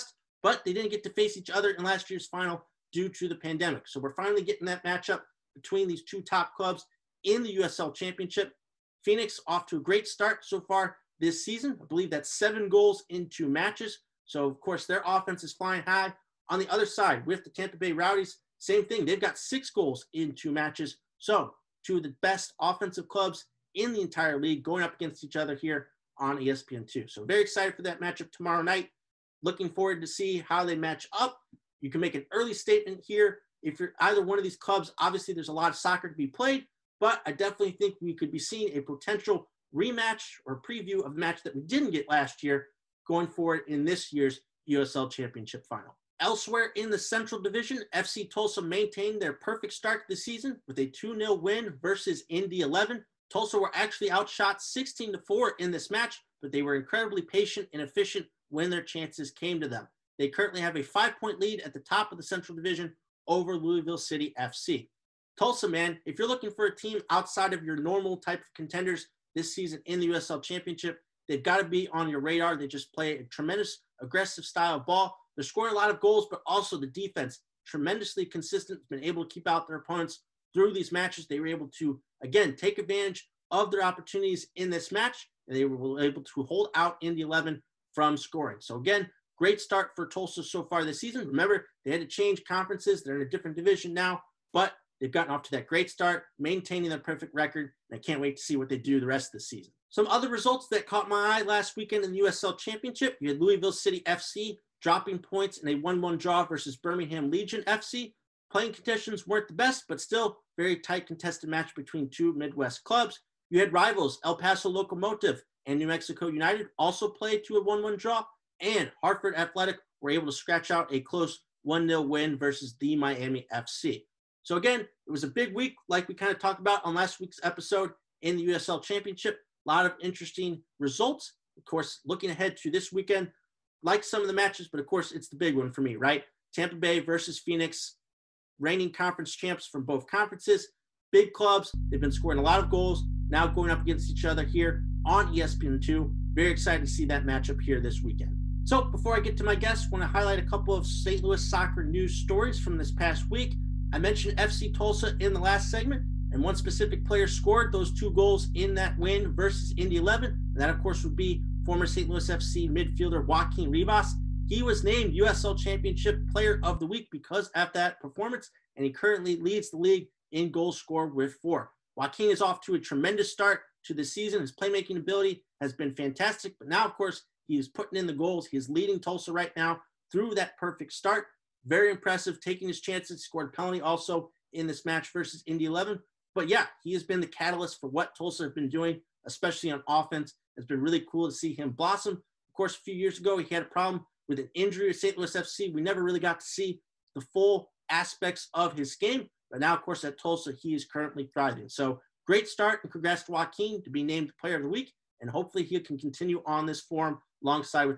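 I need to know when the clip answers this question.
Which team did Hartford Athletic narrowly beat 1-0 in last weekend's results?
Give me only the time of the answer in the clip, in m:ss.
2:02.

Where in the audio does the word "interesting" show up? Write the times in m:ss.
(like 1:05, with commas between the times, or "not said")
2:10.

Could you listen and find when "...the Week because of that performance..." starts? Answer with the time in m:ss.
2:46.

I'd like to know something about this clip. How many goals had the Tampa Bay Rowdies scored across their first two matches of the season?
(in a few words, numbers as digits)
6.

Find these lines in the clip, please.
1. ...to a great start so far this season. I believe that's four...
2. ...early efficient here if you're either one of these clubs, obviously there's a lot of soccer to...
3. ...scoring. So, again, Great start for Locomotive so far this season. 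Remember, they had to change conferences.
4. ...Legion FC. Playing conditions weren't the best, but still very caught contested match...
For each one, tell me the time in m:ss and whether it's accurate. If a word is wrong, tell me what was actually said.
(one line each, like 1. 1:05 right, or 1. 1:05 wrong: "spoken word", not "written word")
1. 0:09 wrong: "seven", not "four"
2. 0:32 wrong: "statement", not "efficient"
3. 1:28 wrong: "Tulsa", not "Locomotive"
4. 1:47 wrong: "tight", not "caught".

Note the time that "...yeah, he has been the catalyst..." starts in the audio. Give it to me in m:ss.
3:06.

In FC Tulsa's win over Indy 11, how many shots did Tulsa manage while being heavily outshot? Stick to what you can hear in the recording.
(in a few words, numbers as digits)
4.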